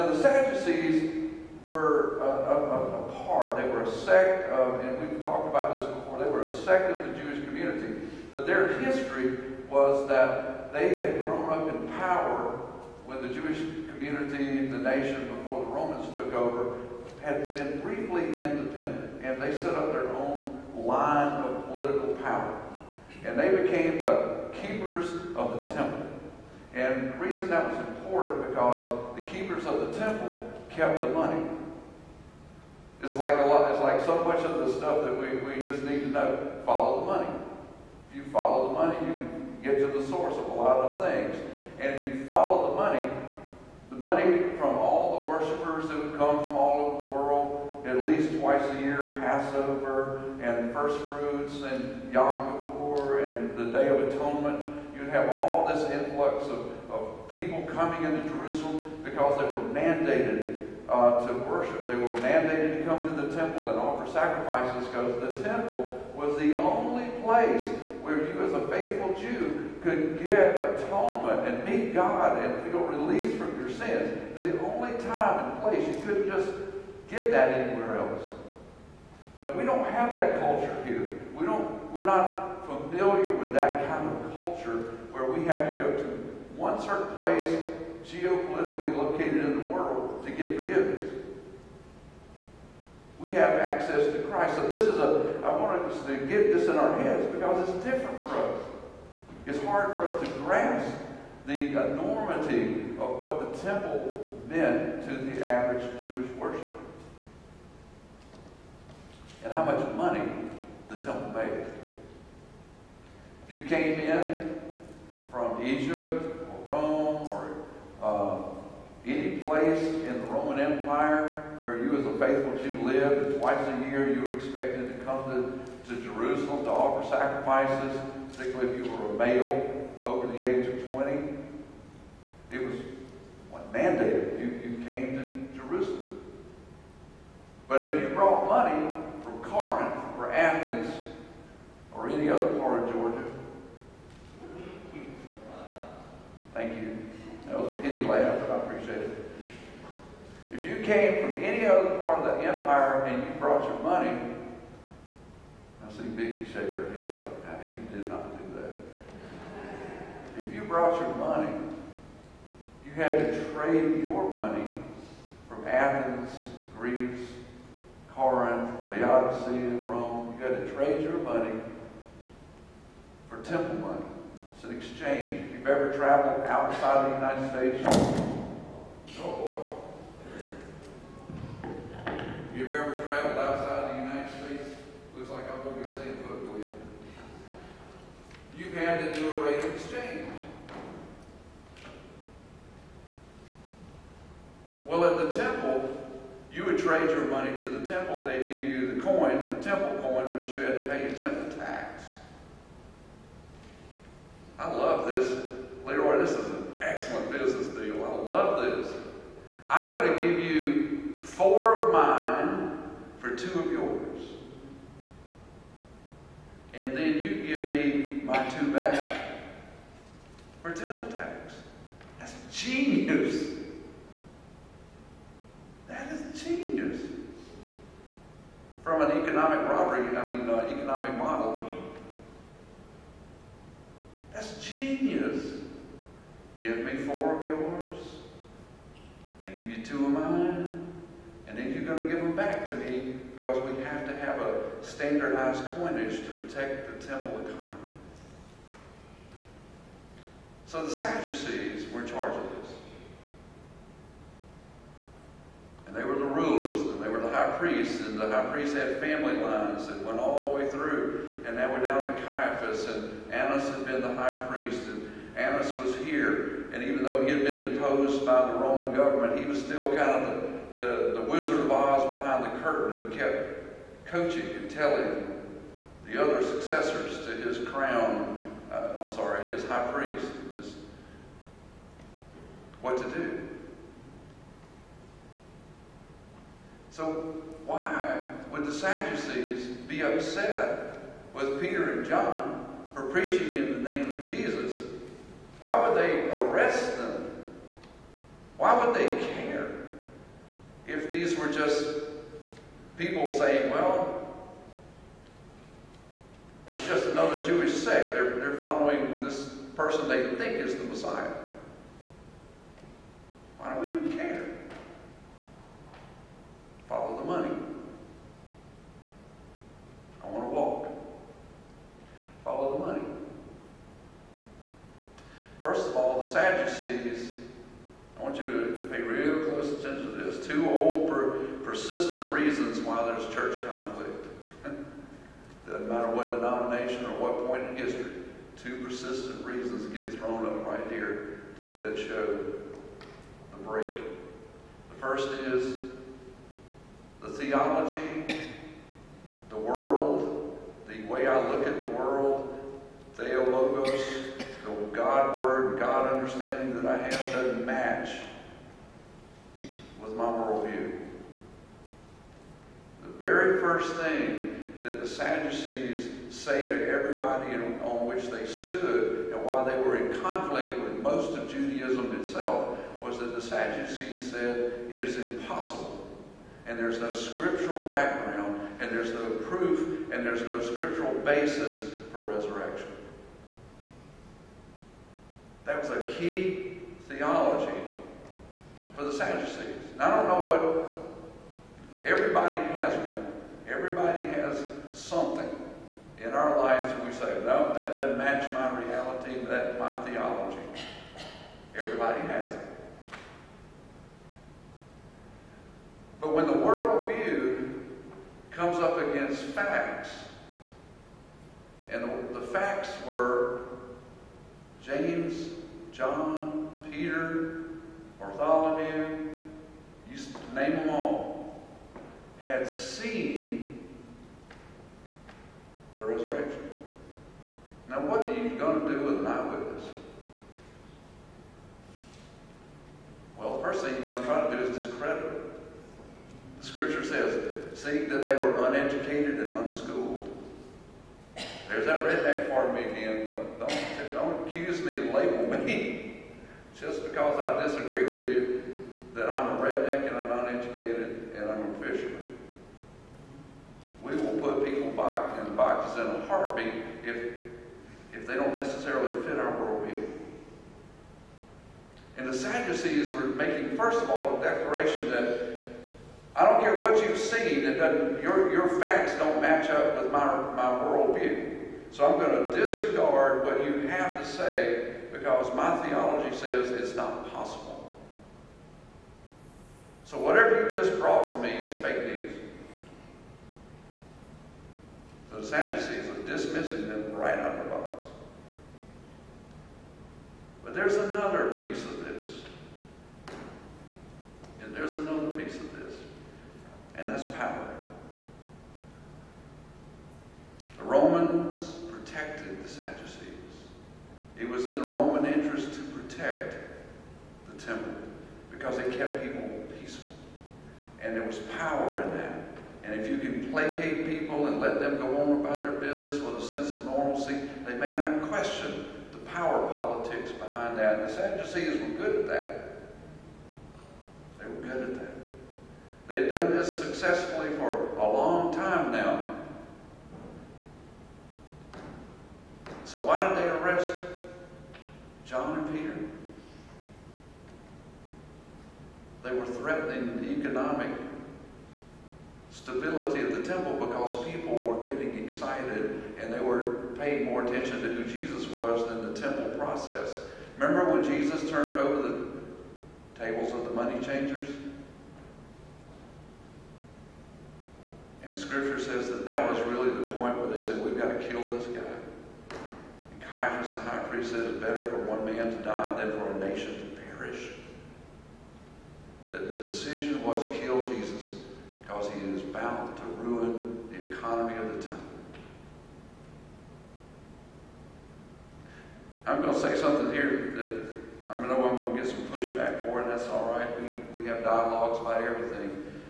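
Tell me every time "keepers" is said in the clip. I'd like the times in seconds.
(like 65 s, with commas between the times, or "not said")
24 s, 29 s.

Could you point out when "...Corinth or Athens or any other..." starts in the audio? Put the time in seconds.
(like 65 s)
139 s.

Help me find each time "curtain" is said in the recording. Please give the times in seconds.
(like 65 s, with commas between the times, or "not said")
272 s.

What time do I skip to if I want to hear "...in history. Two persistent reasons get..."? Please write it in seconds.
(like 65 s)
337 s.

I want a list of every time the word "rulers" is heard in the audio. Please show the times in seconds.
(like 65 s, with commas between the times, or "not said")
256 s.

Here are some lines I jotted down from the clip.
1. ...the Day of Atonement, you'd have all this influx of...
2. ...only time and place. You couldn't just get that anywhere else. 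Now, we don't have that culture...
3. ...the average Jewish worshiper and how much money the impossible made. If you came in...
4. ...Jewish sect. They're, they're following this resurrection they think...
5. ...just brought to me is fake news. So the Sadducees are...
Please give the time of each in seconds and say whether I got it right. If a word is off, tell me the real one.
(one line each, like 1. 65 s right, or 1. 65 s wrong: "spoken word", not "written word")
1. 53 s right
2. 74 s right
3. 105 s wrong: "temple", not "impossible"
4. 307 s wrong: "person", not "resurrection"
5. 480 s right.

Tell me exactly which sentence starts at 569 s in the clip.
That the decision was kill Jesus because he is bound to ruin the economy of the temple.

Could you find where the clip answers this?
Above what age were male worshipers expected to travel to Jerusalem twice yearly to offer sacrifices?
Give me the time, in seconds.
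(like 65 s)
130 s.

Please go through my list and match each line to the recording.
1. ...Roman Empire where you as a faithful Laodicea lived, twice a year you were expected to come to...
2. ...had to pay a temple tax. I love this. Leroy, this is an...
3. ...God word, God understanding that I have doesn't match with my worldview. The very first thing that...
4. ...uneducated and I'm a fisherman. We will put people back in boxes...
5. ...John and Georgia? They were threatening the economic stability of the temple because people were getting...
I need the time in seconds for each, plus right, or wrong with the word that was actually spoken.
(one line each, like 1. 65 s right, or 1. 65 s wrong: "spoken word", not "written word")
1. 120 s wrong: "Jew", not "Laodicea"
2. 200 s right
3. 354 s right
4. 450 s right
5. 535 s wrong: "Peter", not "Georgia".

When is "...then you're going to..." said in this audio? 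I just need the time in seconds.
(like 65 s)
241 s.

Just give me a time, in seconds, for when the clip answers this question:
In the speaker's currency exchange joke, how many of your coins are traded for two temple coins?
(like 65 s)
211 s.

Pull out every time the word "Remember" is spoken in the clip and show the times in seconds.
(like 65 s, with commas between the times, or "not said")
550 s.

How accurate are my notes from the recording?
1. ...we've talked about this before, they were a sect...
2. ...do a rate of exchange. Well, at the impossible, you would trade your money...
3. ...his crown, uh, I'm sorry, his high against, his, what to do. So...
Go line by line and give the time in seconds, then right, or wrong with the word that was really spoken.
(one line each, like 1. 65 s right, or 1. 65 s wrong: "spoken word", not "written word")
1. 5 s right
2. 189 s wrong: "temple", not "impossible"
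3. 277 s wrong: "priest", not "against".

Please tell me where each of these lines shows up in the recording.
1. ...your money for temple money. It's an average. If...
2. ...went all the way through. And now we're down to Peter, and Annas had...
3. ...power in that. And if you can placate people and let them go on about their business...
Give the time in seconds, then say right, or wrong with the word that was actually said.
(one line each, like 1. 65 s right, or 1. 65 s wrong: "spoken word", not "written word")
1. 171 s wrong: "exchange", not "average"
2. 260 s wrong: "Caiaphas", not "Peter"
3. 511 s right.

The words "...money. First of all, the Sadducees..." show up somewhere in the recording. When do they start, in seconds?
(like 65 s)
322 s.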